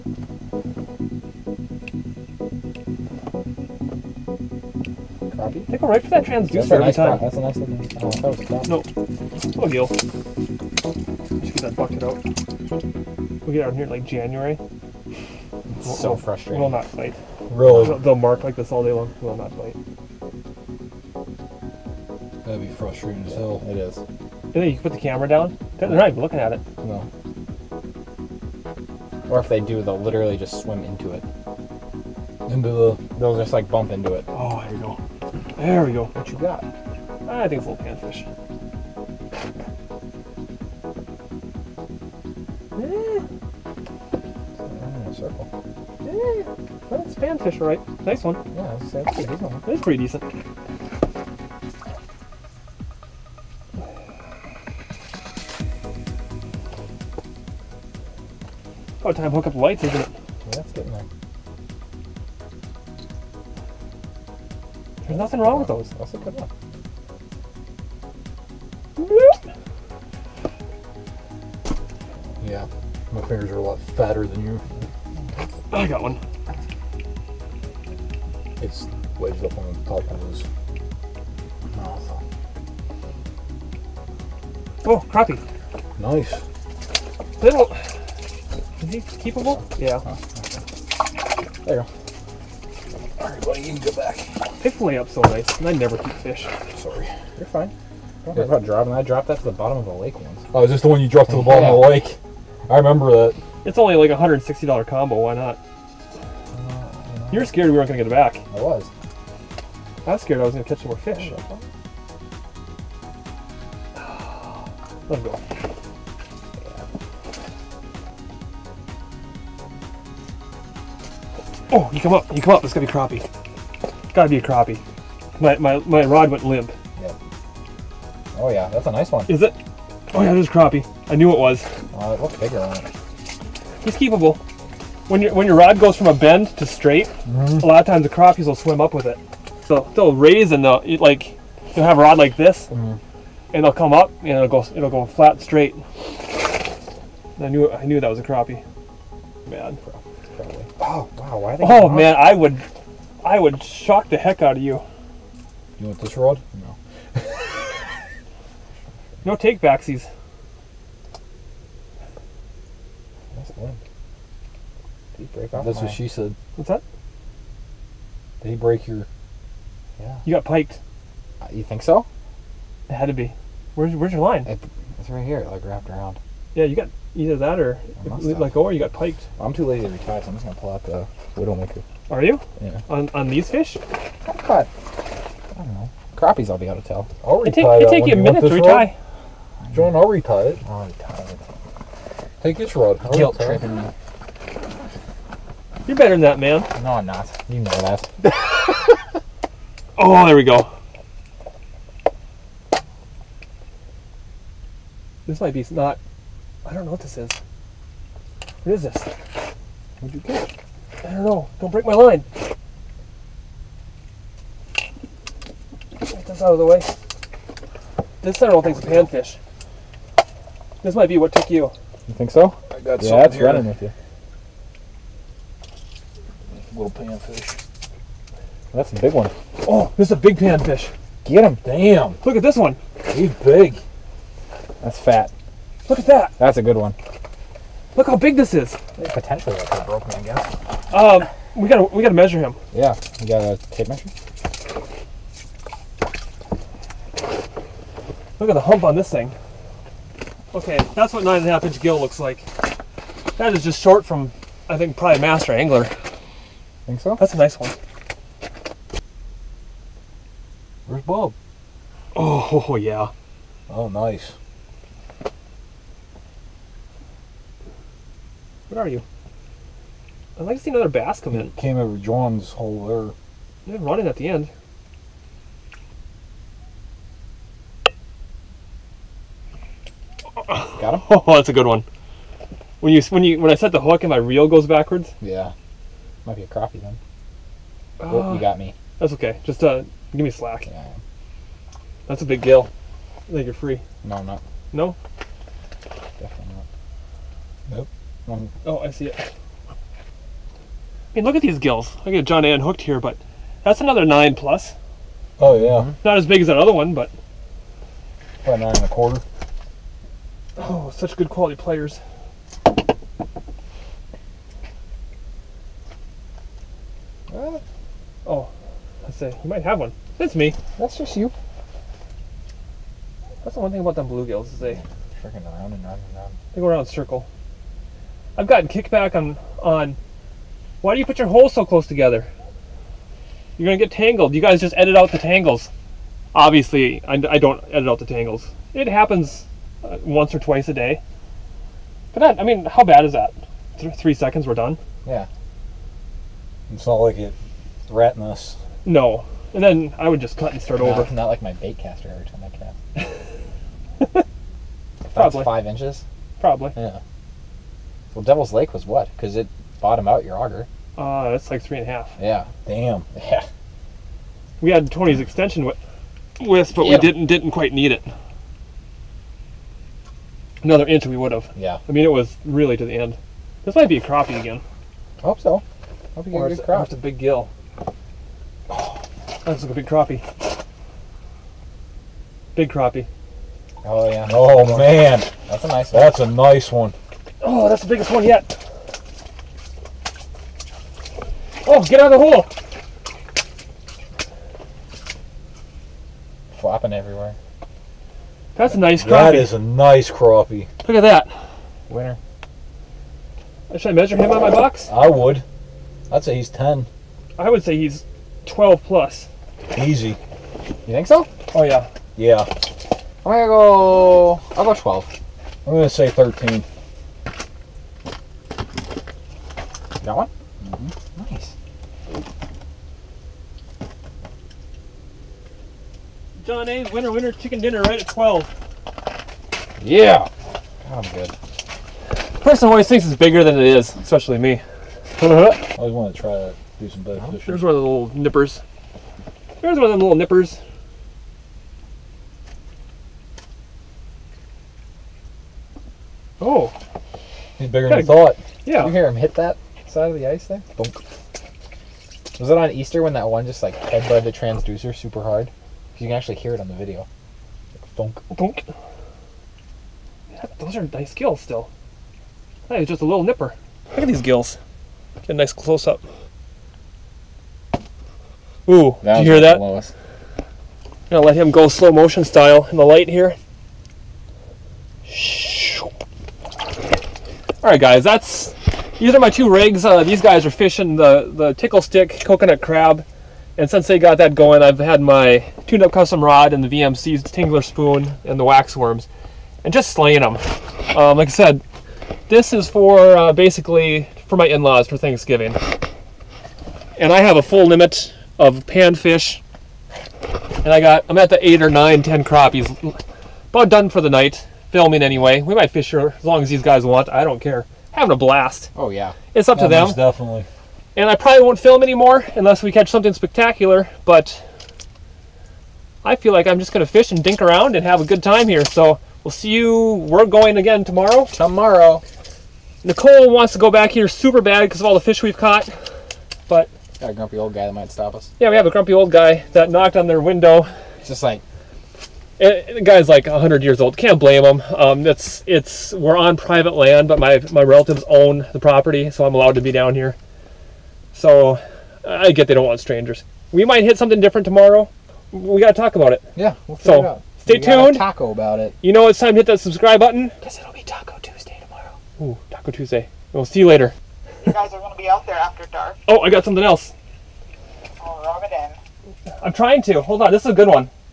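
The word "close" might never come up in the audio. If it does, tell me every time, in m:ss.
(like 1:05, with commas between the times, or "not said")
5:31, 7:45.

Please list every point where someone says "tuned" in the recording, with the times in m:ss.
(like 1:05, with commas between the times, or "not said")
8:05, 9:07.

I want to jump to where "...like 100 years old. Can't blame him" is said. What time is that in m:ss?
8:53.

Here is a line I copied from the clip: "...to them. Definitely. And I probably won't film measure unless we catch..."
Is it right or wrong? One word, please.
wrong.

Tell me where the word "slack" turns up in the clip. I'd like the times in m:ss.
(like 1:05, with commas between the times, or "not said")
4:50.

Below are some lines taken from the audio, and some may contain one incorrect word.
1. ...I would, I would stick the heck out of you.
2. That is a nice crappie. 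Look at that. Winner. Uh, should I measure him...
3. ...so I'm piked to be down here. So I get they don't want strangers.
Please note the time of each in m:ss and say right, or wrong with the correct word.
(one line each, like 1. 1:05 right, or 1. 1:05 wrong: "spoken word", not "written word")
1. 2:32 wrong: "shock", not "stick"
2. 6:39 right
3. 8:59 wrong: "allowed", not "piked".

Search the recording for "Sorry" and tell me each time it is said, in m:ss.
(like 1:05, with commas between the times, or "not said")
1:36.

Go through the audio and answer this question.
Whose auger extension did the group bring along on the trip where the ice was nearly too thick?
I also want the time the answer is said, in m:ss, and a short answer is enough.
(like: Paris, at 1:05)
Tony's, at 6:04.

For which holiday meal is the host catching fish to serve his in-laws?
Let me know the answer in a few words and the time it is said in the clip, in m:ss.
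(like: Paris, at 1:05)
Thanksgiving, at 8:14.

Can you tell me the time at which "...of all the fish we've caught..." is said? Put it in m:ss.
8:44.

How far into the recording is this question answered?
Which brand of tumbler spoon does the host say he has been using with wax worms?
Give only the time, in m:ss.
8:06.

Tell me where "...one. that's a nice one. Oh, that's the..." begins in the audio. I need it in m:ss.
6:25.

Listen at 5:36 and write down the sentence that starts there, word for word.
Obviously, I, I don't edit out the tangles.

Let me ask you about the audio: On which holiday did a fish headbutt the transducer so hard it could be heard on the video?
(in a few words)
Easter.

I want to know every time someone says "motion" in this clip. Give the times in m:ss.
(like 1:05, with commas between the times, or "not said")
7:51.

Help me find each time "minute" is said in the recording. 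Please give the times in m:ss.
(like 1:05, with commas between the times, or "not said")
3:08.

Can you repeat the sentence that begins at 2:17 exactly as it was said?
a lot of times the crappies will swim up with it.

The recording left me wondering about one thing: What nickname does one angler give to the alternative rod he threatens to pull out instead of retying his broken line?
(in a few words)
the widowmaker.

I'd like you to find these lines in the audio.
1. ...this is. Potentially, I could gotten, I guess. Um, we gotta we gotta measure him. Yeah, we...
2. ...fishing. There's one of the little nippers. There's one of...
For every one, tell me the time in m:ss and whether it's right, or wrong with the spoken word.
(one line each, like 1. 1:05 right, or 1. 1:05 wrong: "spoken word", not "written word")
1. 3:58 wrong: "broken", not "gotten"
2. 7:17 right.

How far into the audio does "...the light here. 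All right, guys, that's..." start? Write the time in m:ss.
7:52.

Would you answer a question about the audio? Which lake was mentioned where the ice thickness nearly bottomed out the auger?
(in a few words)
Devil's Lake.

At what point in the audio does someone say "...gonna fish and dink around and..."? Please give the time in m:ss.
8:36.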